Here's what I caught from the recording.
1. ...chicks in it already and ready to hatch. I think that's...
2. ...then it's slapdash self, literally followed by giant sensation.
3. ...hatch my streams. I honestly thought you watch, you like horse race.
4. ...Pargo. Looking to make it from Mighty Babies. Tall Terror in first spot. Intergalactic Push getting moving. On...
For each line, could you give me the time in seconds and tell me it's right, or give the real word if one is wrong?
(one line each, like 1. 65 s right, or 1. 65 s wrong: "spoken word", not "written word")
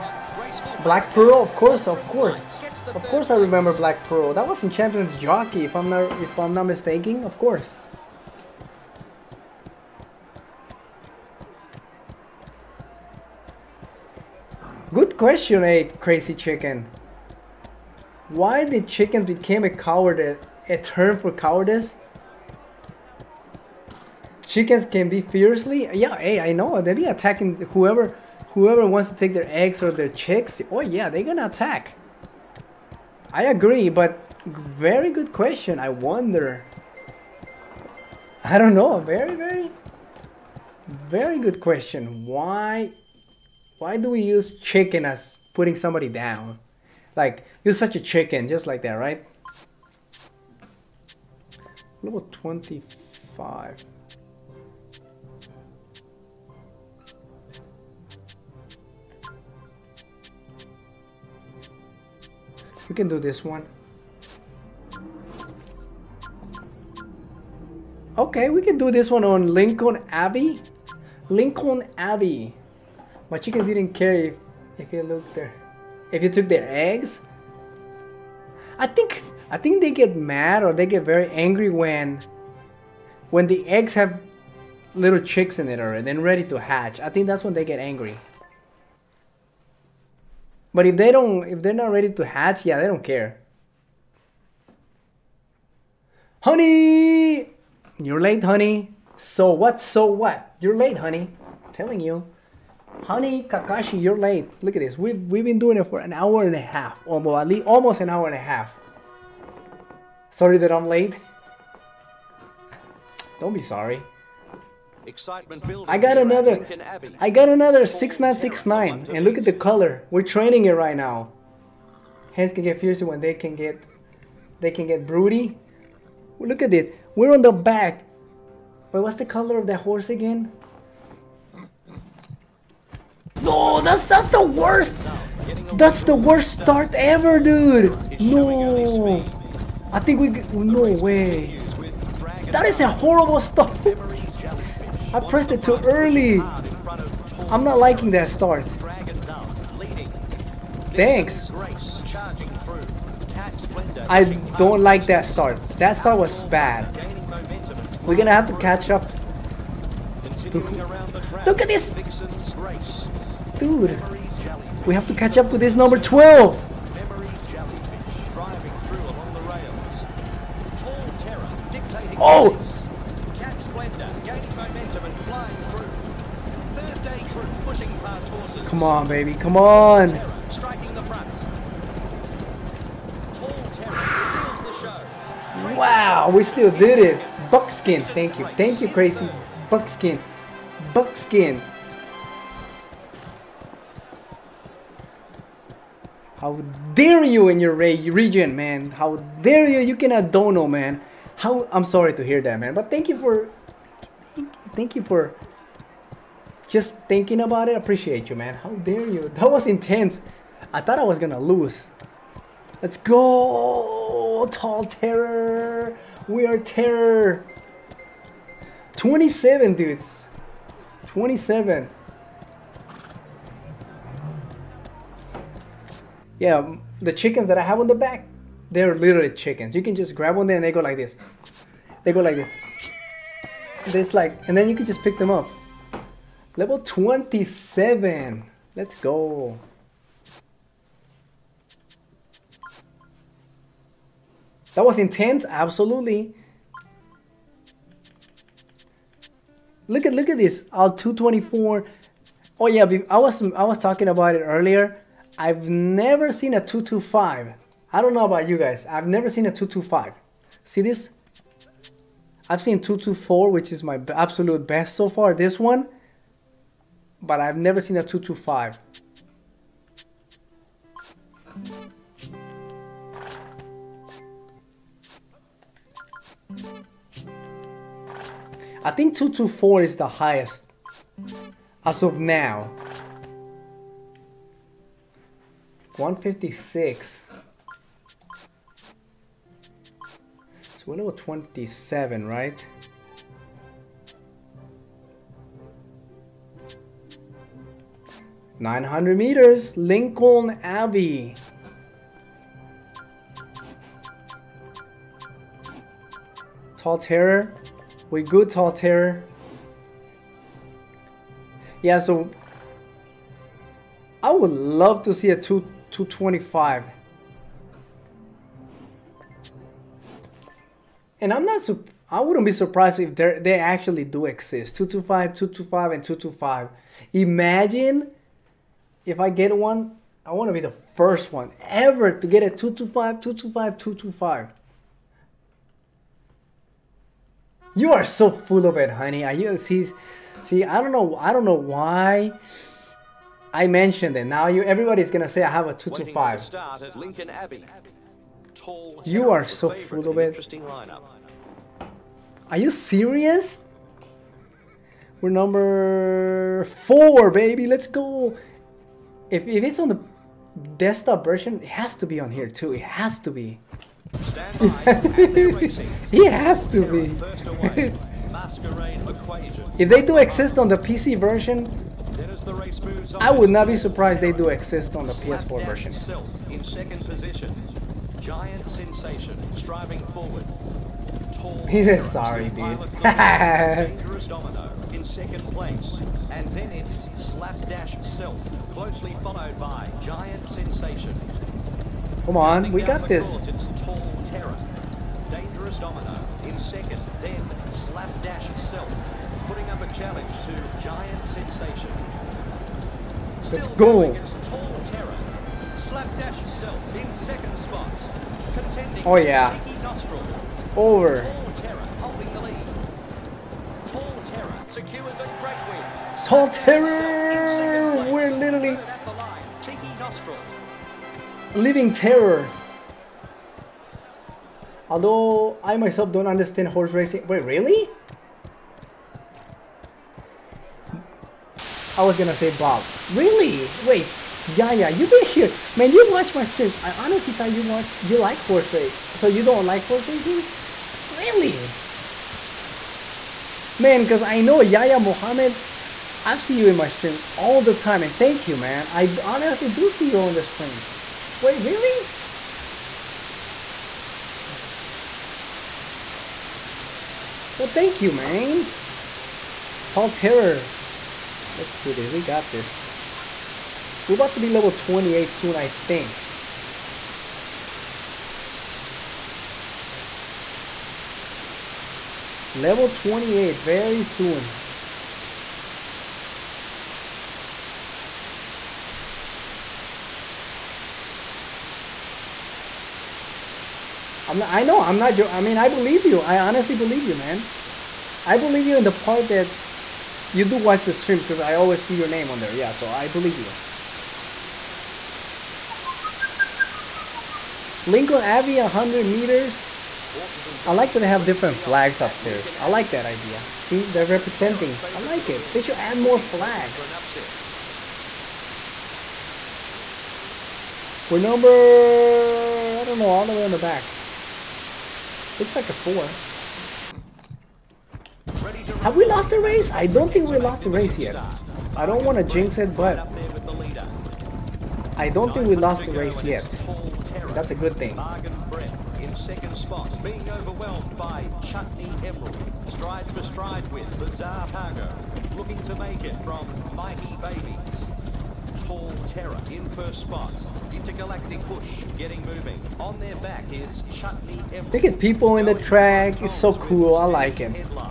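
1. 85 s right
2. 386 s wrong: "closely", not "literally"
3. 436 s wrong: "watch", not "hatch"
4. 534 s right.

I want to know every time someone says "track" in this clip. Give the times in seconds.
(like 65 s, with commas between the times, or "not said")
545 s.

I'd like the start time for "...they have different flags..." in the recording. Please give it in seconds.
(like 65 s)
500 s.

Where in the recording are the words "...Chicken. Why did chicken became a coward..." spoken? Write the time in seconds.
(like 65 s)
16 s.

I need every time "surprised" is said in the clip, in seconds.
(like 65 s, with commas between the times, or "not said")
322 s, 373 s.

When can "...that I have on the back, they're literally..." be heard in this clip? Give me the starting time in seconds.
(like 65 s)
227 s.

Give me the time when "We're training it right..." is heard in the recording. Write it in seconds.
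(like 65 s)
120 s.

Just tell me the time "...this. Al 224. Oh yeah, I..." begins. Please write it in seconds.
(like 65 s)
250 s.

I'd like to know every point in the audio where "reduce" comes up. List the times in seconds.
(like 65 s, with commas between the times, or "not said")
not said.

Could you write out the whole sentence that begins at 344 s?
Now you, everybody's gonna say I have a two to five.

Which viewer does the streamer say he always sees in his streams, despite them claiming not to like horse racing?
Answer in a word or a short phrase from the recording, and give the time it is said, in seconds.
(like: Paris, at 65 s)
Yaya Mohammed, at 444 s.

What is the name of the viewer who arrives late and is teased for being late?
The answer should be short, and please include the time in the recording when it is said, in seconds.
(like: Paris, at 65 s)
Kakashi, at 103 s.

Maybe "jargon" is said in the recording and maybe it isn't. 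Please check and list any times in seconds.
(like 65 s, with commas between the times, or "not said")
not said.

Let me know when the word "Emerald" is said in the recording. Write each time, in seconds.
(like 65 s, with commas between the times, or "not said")
532 s, 544 s.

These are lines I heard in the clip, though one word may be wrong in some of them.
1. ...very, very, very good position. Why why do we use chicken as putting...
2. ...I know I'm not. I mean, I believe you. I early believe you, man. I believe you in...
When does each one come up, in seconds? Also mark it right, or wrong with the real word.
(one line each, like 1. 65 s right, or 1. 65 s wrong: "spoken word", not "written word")
1. 39 s wrong: "question", not "position"
2. 484 s wrong: "honestly", not "early".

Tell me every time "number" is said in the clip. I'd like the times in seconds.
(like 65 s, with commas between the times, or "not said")
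355 s, 511 s.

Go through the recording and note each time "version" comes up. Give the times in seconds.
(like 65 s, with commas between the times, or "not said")
361 s, 371 s, 375 s.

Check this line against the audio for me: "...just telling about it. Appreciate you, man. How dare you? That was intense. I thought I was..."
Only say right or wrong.
wrong.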